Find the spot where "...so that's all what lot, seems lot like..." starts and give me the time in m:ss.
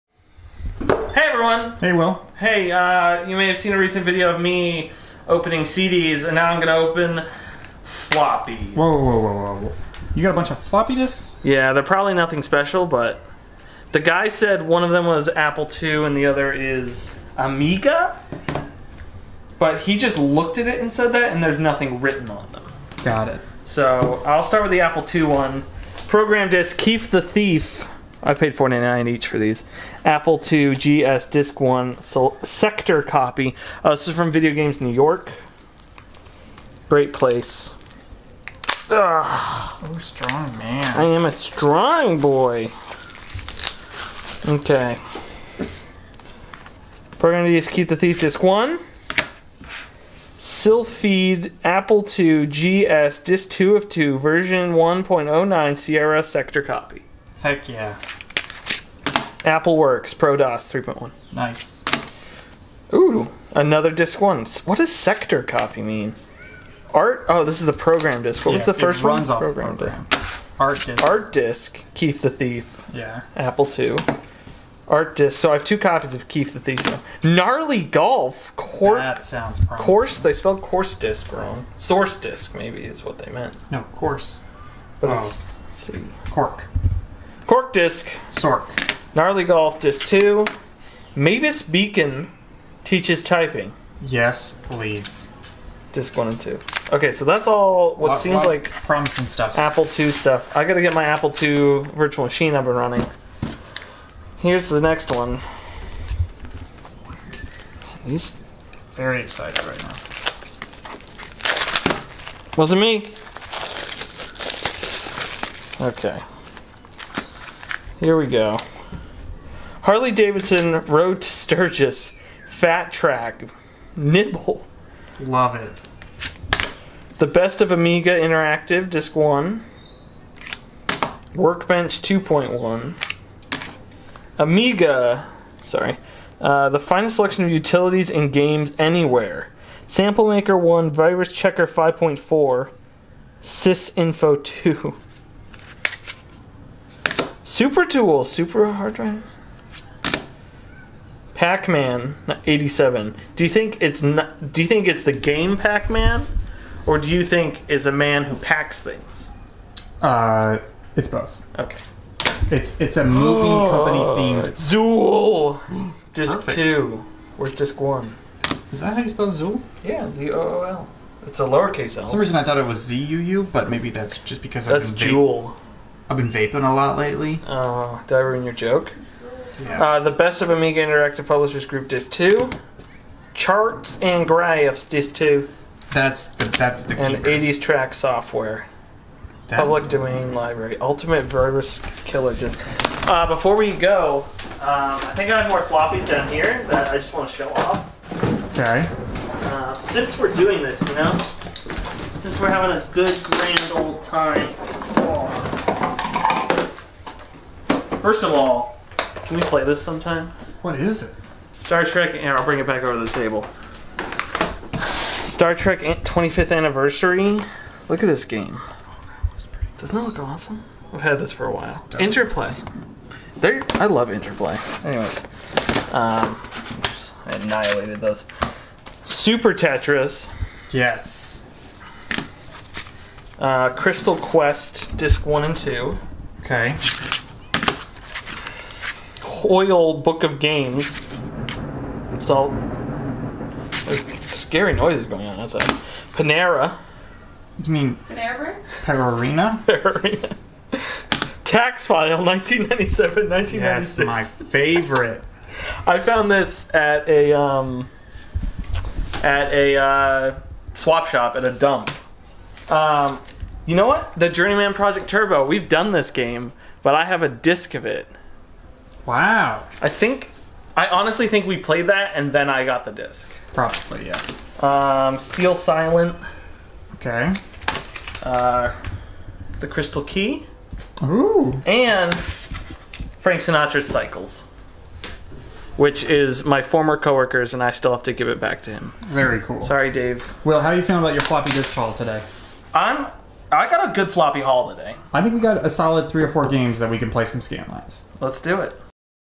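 1:37.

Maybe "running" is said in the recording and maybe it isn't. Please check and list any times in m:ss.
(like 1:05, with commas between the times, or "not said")
1:42.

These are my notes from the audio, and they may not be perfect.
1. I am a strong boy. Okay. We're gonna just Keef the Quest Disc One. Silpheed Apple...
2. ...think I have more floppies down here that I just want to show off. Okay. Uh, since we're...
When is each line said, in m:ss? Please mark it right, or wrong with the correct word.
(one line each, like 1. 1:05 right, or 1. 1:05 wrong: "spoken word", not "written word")
1. 0:40 wrong: "Thief", not "Quest"
2. 3:15 right.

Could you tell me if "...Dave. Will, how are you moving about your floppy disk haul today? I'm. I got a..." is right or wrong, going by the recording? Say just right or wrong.
wrong.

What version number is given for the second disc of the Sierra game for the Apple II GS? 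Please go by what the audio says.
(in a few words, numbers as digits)
1.09.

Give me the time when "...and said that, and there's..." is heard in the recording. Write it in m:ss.
0:20.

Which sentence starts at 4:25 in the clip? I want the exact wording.
We've done this game, but I have a disc of it.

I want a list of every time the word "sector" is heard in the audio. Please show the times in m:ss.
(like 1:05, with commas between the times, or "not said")
0:32, 0:56, 1:04.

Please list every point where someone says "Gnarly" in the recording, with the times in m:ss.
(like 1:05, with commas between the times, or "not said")
1:17, 1:29.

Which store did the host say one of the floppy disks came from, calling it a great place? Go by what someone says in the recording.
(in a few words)
Video Games New York.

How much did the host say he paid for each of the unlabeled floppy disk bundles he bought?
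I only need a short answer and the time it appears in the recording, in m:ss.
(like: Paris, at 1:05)
$4.99, at 0:28.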